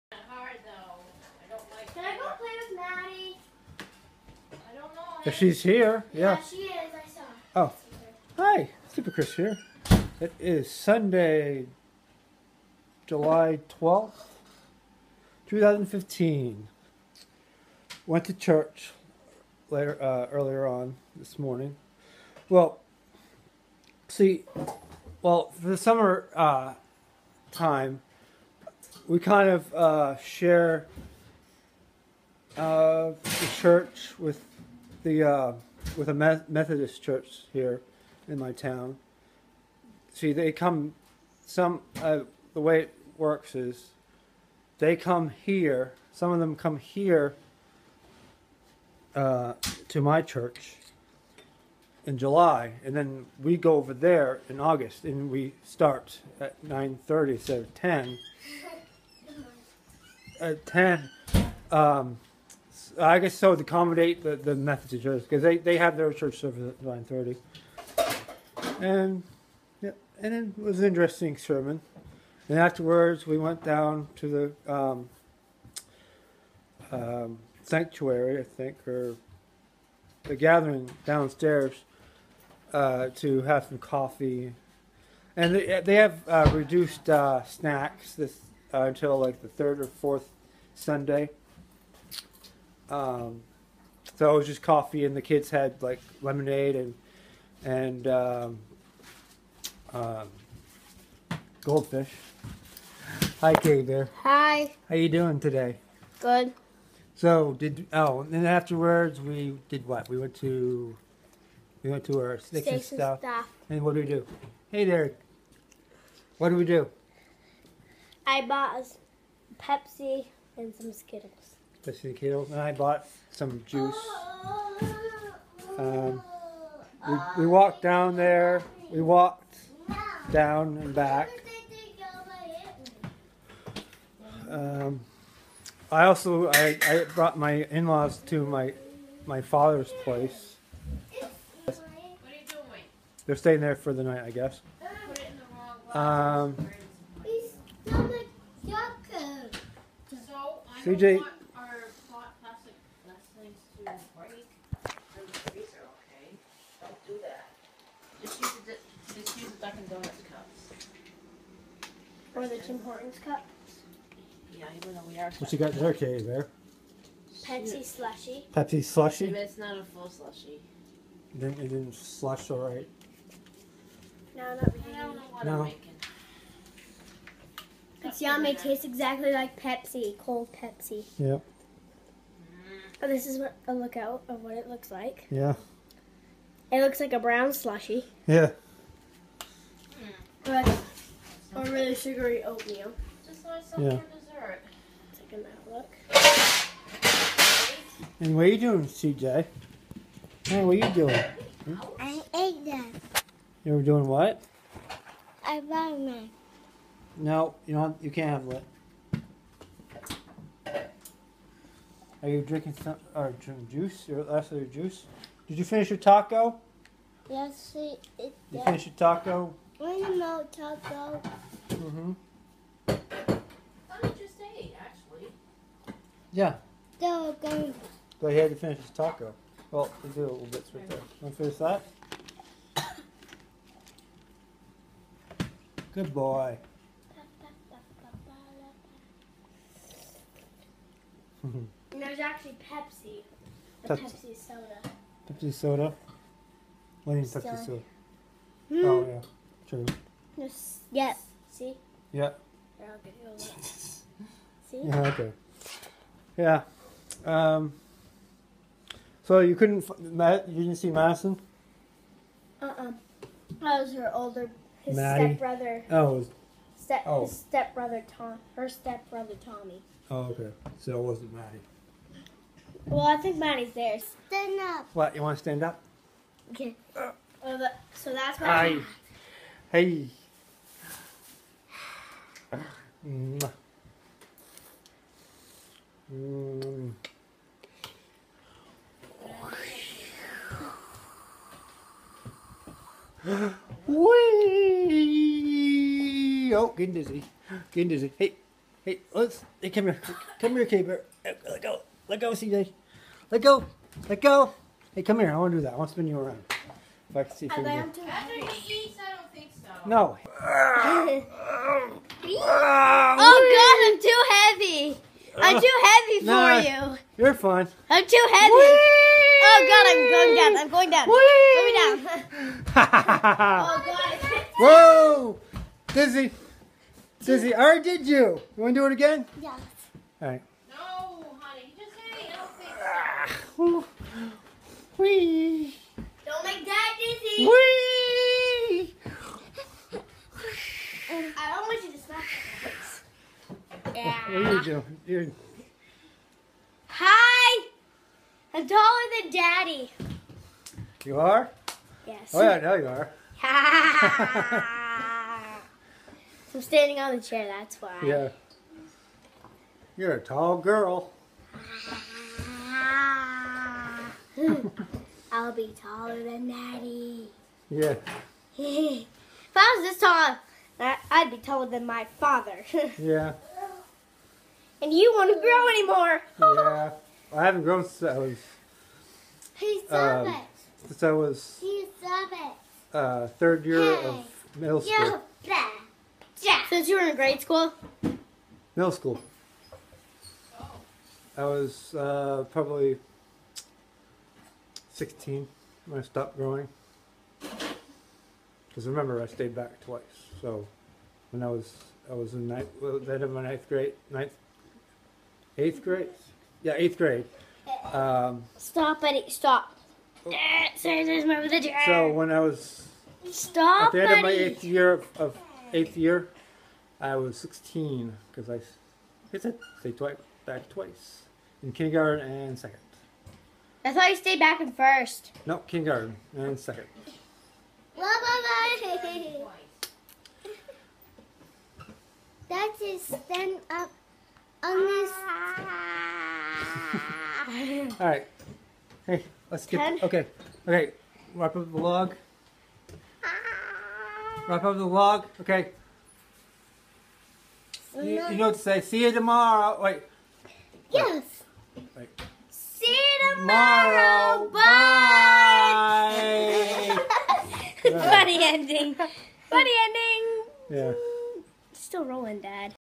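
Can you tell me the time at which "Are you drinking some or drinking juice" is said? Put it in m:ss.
3:32.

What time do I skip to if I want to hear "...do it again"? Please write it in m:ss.
5:28.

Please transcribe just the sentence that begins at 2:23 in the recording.
They're staying there for the night, I guess.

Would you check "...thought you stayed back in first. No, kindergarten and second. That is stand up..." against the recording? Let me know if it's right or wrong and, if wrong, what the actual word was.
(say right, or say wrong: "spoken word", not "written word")
right.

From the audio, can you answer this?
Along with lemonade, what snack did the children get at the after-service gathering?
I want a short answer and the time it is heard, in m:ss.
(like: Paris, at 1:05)
goldfish, at 1:41.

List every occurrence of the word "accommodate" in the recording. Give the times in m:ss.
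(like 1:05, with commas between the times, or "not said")
1:03.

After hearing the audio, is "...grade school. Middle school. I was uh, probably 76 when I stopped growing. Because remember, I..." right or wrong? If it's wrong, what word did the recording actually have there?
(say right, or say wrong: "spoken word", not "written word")
wrong: "16", not "76".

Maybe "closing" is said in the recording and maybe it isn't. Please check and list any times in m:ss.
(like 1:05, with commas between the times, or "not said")
not said.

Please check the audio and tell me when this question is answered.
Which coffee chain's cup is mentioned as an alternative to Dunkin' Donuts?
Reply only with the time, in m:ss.
2:42.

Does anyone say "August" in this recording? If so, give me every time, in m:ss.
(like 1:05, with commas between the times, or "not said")
0:54.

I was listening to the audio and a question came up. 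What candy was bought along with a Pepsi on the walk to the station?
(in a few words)
Skittles.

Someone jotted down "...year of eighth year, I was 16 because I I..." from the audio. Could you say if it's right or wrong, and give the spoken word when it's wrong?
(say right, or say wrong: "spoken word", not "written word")
right.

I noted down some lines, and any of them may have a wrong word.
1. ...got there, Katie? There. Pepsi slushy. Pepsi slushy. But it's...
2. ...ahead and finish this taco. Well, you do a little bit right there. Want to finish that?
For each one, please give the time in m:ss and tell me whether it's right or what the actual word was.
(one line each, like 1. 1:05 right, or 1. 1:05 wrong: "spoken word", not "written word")
1. 2:45 right
2. 3:48 right.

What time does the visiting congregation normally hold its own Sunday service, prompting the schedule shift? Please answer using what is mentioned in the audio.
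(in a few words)
9:30.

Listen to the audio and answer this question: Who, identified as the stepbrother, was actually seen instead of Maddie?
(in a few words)
Tommy.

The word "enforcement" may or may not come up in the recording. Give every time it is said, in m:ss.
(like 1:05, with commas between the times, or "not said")
not said.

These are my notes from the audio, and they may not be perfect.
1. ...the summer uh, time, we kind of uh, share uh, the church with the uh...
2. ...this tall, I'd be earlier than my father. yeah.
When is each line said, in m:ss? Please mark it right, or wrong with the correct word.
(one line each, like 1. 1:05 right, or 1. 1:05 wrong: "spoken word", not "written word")
1. 0:25 right
2. 6:09 wrong: "taller", not "earlier".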